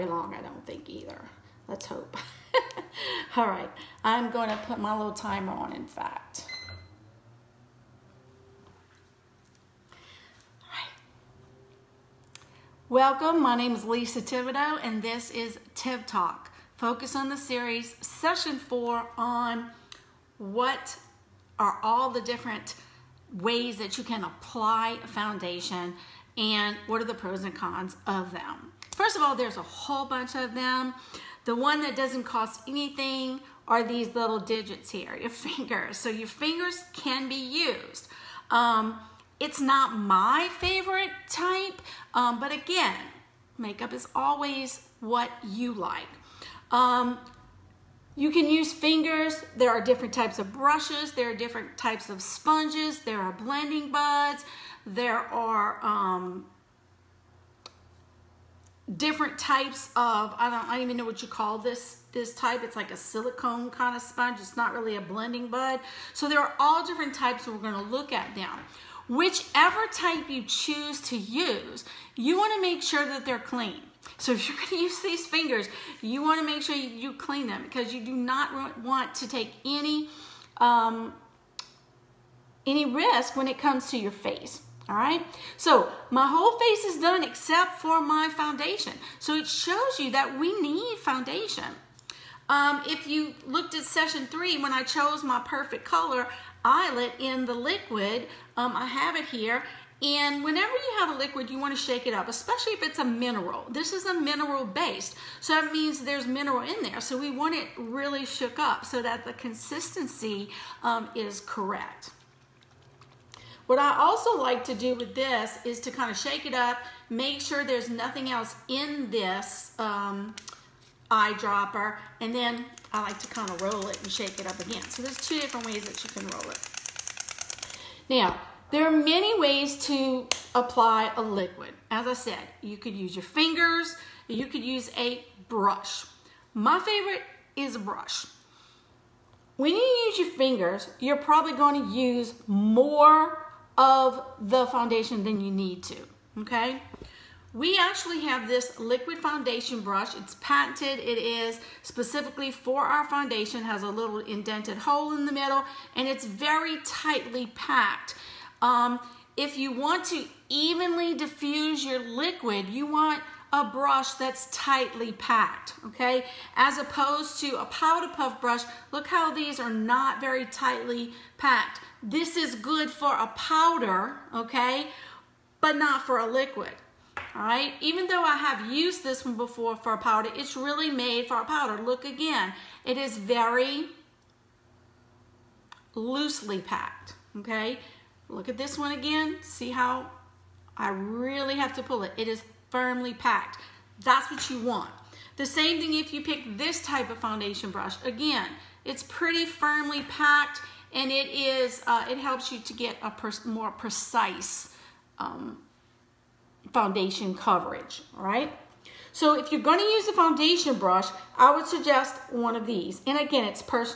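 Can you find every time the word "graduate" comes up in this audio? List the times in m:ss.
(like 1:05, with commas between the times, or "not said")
not said.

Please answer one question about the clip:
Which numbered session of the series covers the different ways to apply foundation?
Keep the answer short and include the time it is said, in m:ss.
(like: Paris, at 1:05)
4, at 0:18.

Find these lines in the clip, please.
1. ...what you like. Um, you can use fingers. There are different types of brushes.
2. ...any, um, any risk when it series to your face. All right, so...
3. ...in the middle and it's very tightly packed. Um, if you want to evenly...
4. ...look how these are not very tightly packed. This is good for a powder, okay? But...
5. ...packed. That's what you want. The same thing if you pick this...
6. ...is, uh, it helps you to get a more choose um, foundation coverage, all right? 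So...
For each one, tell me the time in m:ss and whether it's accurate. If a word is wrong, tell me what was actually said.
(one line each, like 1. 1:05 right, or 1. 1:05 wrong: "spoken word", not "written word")
1. 0:45 right
2. 1:19 wrong: "comes", not "series"
3. 2:35 right
4. 2:48 right
5. 3:13 right
6. 3:21 wrong: "precise", not "choose".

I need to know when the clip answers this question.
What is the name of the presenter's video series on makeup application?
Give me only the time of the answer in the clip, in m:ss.
0:15.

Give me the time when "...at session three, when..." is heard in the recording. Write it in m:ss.
1:33.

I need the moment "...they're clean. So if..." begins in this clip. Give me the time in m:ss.
1:13.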